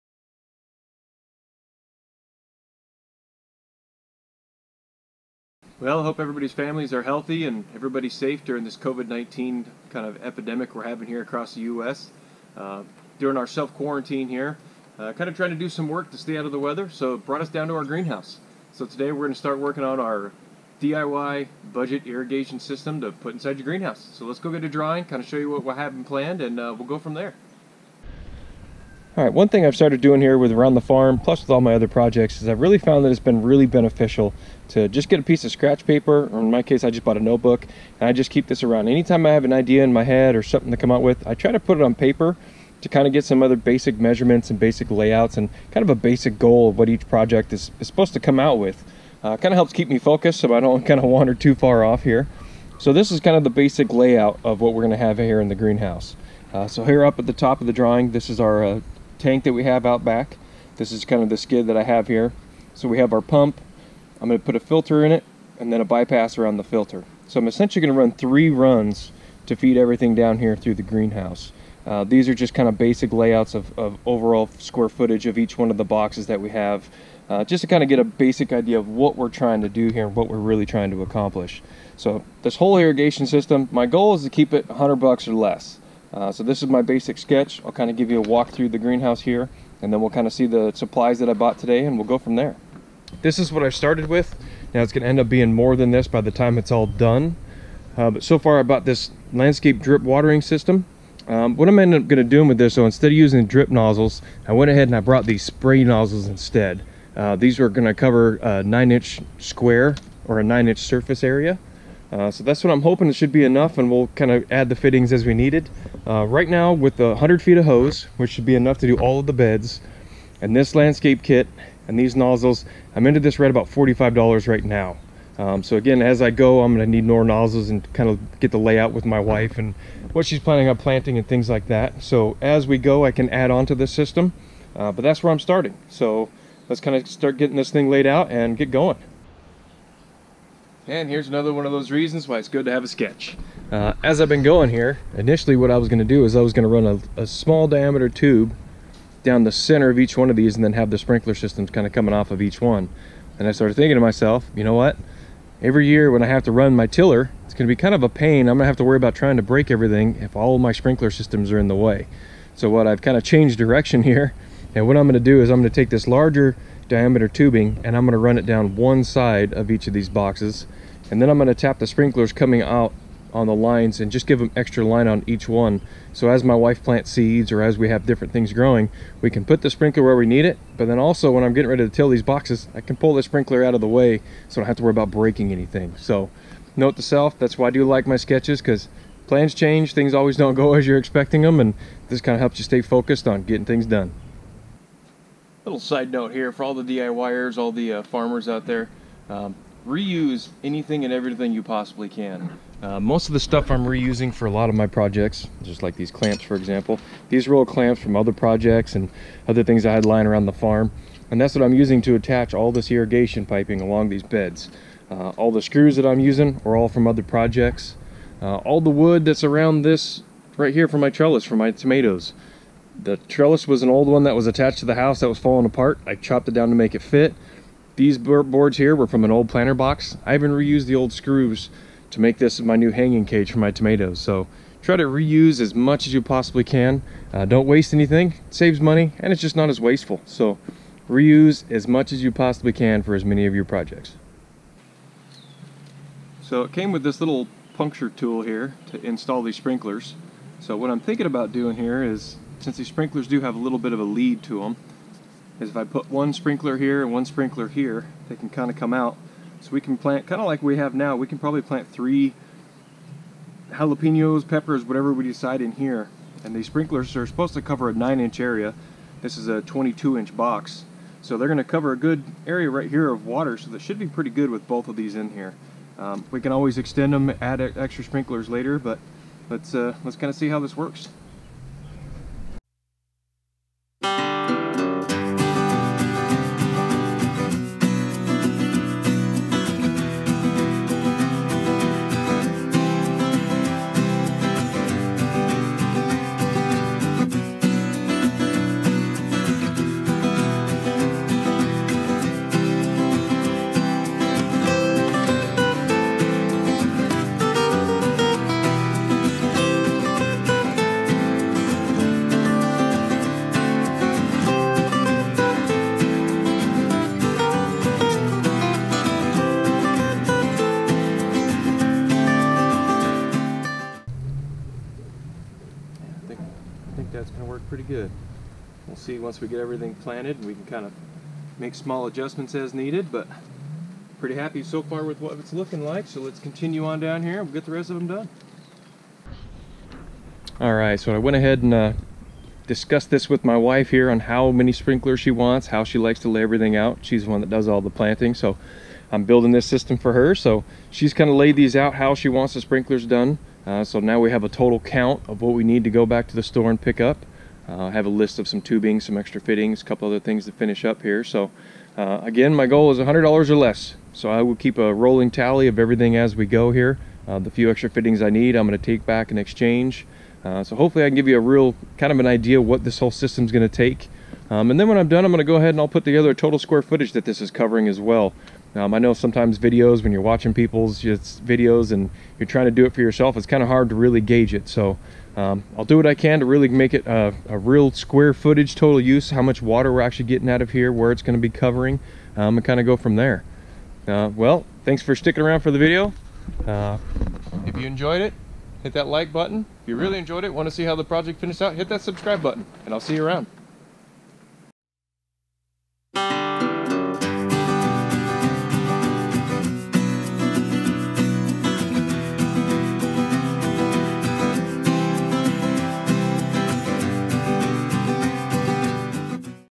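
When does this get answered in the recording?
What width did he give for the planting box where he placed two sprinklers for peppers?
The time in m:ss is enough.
4:29.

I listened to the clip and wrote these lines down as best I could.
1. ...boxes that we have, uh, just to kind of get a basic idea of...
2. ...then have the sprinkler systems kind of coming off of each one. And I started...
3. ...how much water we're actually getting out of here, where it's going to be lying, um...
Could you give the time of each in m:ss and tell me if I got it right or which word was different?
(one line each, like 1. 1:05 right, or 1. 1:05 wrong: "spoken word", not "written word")
1. 1:15 right
2. 2:30 right
3. 6:29 wrong: "covering", not "lying".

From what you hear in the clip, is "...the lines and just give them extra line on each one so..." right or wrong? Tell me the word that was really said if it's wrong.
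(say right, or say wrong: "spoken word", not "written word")
right.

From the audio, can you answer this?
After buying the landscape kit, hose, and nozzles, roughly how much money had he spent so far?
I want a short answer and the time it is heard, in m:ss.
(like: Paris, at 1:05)
$45, at 2:03.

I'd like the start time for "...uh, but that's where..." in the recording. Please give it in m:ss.
2:14.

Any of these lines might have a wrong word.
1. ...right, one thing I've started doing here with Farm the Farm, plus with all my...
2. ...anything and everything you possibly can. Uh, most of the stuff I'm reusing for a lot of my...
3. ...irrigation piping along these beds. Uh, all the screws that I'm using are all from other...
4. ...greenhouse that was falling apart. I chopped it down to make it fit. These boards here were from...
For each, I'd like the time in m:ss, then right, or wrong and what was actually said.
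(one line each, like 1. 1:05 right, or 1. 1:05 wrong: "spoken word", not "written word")
1. 0:29 wrong: "Around", not "Farm"
2. 3:20 right
3. 3:32 right
4. 3:44 wrong: "house", not "greenhouse".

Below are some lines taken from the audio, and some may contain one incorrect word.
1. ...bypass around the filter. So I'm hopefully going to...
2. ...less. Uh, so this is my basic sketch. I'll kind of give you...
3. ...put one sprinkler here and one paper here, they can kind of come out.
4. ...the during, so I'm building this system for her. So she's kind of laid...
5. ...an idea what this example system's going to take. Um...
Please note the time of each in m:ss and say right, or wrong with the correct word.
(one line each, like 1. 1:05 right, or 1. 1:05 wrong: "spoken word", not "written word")
1. 1:05 wrong: "essentially", not "hopefully"
2. 1:25 right
3. 4:15 wrong: "sprinkler", not "paper"
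4. 5:47 wrong: "planting", not "during"
5. 6:12 wrong: "whole", not "example".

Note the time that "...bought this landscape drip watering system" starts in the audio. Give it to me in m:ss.
1:38.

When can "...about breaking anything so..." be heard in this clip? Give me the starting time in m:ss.
3:04.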